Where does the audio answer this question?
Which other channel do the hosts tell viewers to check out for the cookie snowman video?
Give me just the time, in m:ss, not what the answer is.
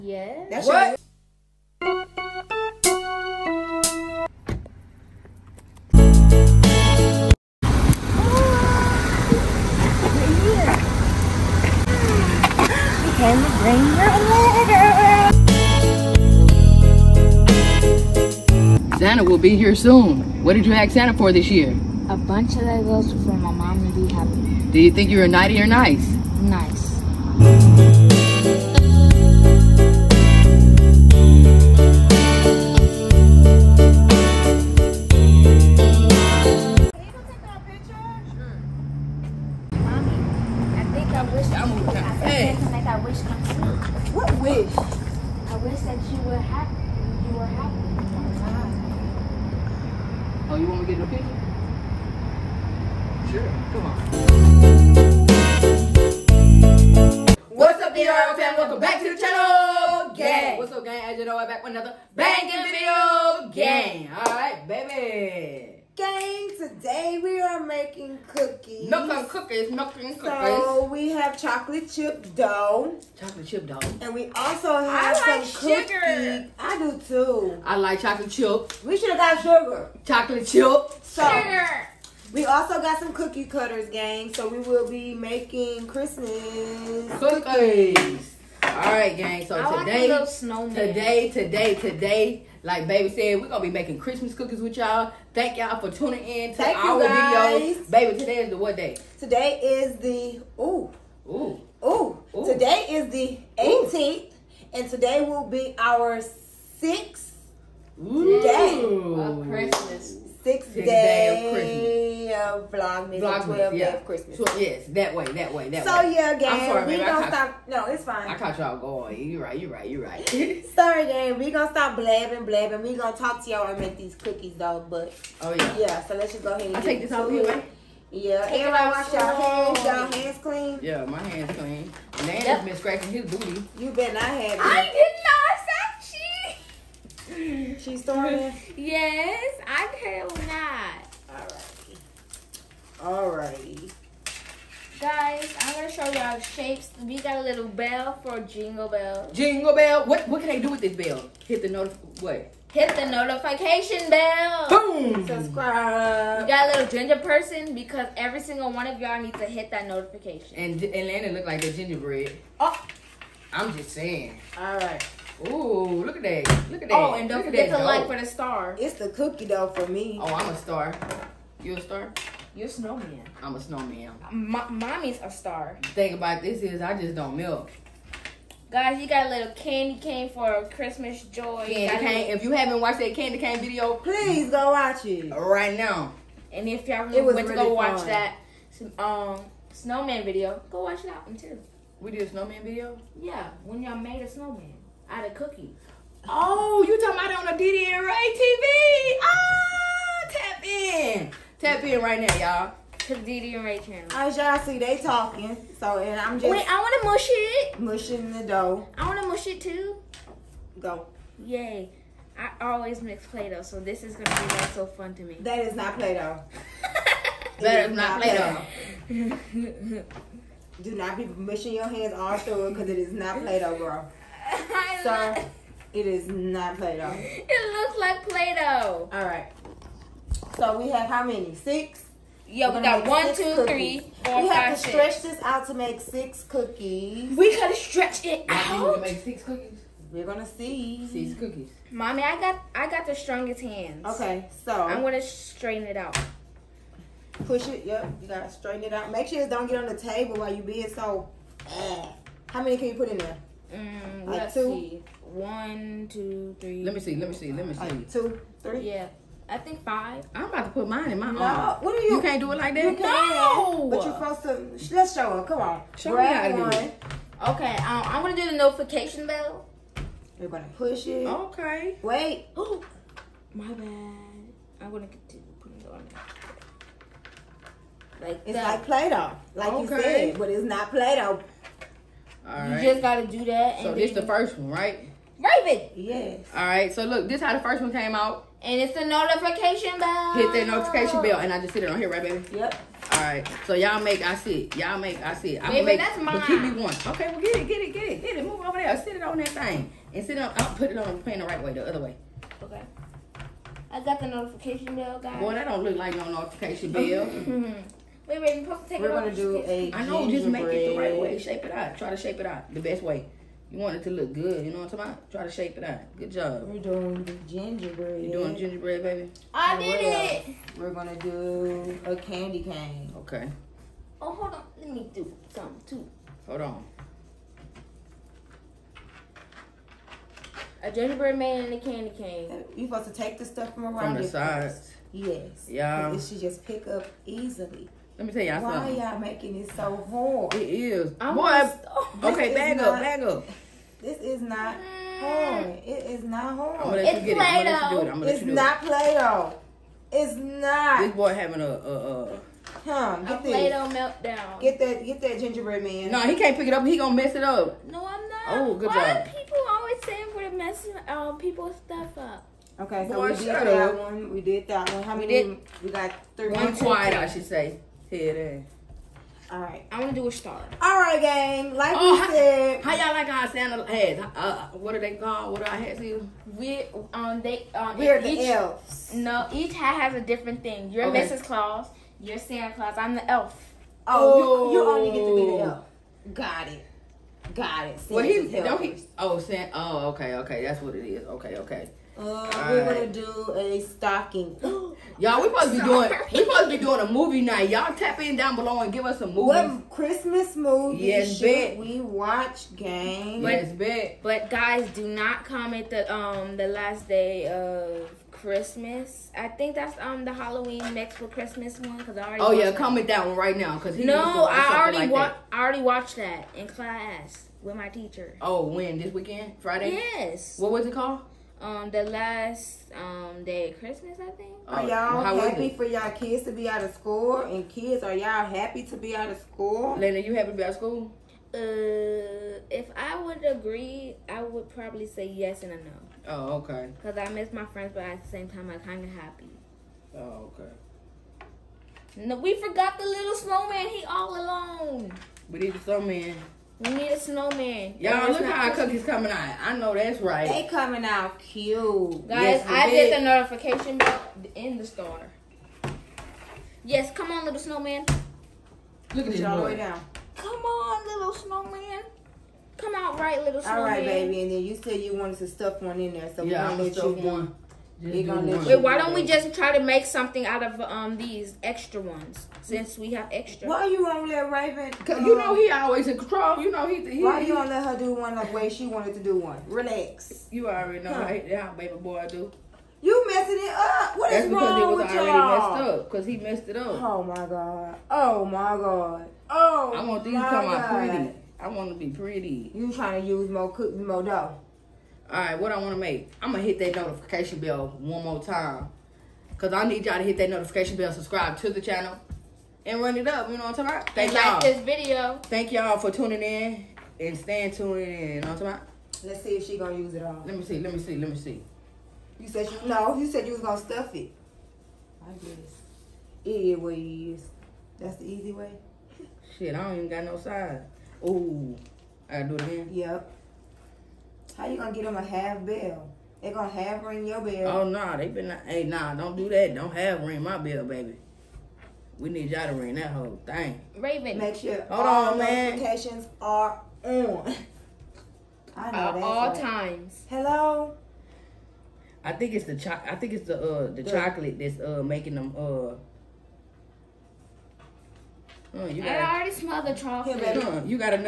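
3:17.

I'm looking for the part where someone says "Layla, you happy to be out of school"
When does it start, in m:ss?
7:09.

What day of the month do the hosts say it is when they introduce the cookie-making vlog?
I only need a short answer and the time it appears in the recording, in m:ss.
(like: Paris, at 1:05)
18th, at 1:42.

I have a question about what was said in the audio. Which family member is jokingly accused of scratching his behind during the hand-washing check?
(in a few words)
Nana.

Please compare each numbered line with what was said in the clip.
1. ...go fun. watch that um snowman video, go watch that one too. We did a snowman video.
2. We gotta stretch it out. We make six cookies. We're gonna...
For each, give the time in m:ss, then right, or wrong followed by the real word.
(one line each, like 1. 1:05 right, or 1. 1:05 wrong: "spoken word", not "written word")
1. 3:07 right
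2. 3:57 right.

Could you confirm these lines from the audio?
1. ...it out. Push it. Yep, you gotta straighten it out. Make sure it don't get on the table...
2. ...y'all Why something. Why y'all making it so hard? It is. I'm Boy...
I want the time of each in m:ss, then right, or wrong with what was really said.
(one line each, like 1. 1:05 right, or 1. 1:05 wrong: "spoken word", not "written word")
1. 4:05 right
2. 5:38 right.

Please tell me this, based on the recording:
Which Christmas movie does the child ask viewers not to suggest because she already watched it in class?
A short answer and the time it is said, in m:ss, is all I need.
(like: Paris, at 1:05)
The Last Day of Christmas, at 6:46.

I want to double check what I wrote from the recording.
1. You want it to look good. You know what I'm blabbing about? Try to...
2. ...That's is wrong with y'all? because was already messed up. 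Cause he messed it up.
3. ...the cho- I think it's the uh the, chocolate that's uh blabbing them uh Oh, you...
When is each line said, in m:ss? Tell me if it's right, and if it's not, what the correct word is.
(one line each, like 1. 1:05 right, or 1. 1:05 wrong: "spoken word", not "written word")
1. 5:13 wrong: "talking", not "blabbing"
2. 8:04 right
3. 9:02 wrong: "making", not "blabbing".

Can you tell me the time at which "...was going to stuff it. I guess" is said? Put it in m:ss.
8:33.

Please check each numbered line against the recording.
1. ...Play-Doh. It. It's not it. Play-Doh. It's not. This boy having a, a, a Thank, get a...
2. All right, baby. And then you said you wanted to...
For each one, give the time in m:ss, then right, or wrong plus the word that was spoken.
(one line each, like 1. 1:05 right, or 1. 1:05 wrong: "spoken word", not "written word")
1. 5:47 wrong: "Huh", not "Thank"
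2. 7:43 right.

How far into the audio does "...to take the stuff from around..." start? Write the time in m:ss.
5:33.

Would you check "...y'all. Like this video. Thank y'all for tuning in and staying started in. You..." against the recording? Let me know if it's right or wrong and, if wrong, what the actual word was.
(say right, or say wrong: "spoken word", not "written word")
wrong: "tuned", not "started".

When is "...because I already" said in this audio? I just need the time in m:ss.
6:51.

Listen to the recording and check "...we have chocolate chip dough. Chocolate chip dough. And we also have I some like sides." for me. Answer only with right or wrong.
wrong.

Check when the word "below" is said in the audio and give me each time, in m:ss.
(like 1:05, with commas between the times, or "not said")
6:38.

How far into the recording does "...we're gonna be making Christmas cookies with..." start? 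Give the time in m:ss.
1:33.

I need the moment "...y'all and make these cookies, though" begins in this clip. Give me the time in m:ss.
2:03.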